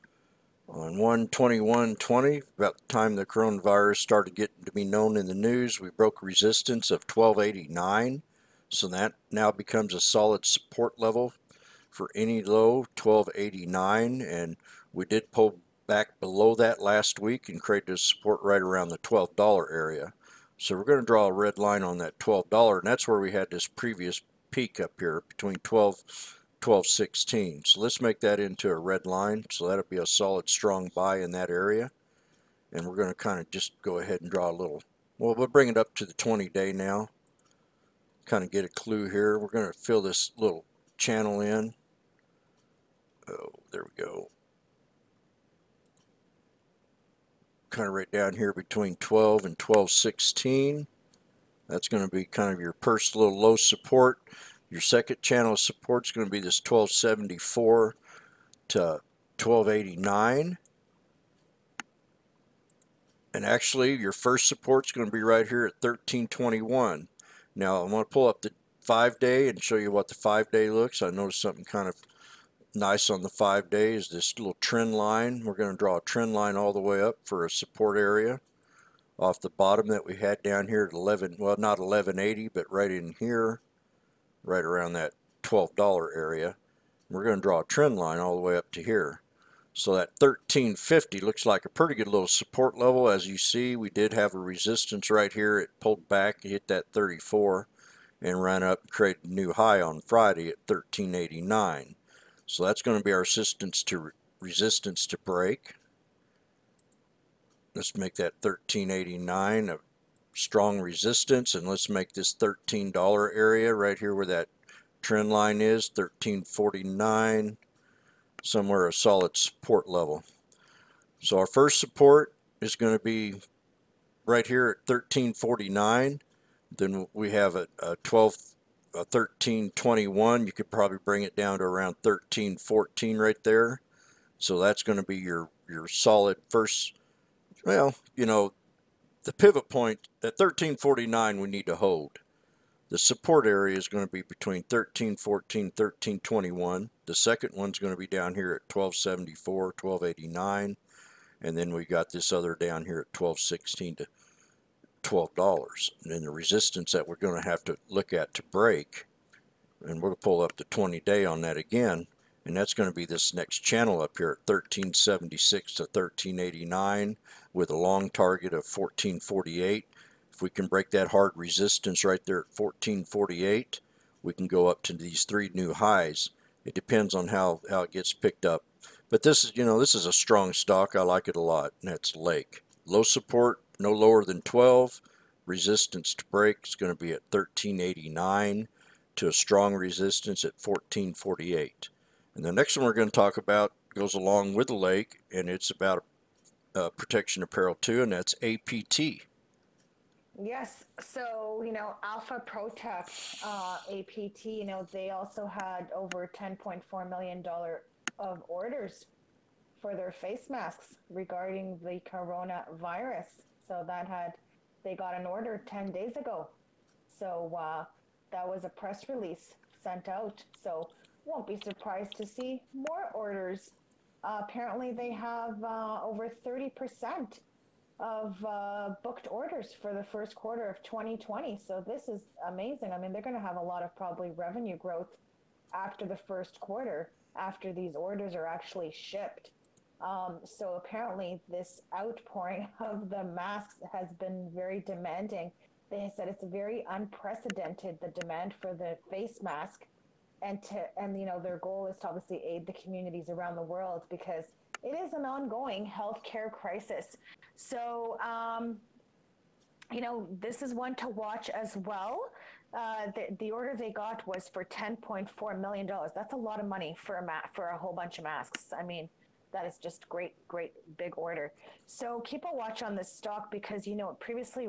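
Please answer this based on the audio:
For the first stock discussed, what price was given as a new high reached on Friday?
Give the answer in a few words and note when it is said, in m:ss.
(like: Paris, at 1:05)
13.89, at 1:38.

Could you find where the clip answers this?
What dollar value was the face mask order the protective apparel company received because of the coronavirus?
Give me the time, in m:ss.
3:26.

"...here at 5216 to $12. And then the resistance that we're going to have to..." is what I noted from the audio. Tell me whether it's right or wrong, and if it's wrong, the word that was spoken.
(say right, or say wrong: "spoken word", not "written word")
wrong: "1216", not "5216".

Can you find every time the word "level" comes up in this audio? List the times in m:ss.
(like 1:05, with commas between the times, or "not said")
0:10, 1:32, 1:59.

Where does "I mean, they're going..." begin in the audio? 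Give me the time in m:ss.
3:52.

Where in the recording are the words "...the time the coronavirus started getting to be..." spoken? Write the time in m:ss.
0:02.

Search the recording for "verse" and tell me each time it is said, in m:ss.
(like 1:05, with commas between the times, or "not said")
not said.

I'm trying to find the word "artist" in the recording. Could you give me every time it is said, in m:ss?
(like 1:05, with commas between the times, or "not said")
not said.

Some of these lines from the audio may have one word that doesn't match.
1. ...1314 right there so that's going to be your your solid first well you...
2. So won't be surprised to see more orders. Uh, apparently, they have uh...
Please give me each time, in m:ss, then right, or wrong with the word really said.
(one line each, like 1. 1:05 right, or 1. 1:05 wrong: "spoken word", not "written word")
1. 2:12 right
2. 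3:40 right.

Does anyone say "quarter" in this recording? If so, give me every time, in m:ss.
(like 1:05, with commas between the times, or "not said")
3:50, 3:56.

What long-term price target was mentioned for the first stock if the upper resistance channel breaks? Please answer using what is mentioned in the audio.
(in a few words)
14.48.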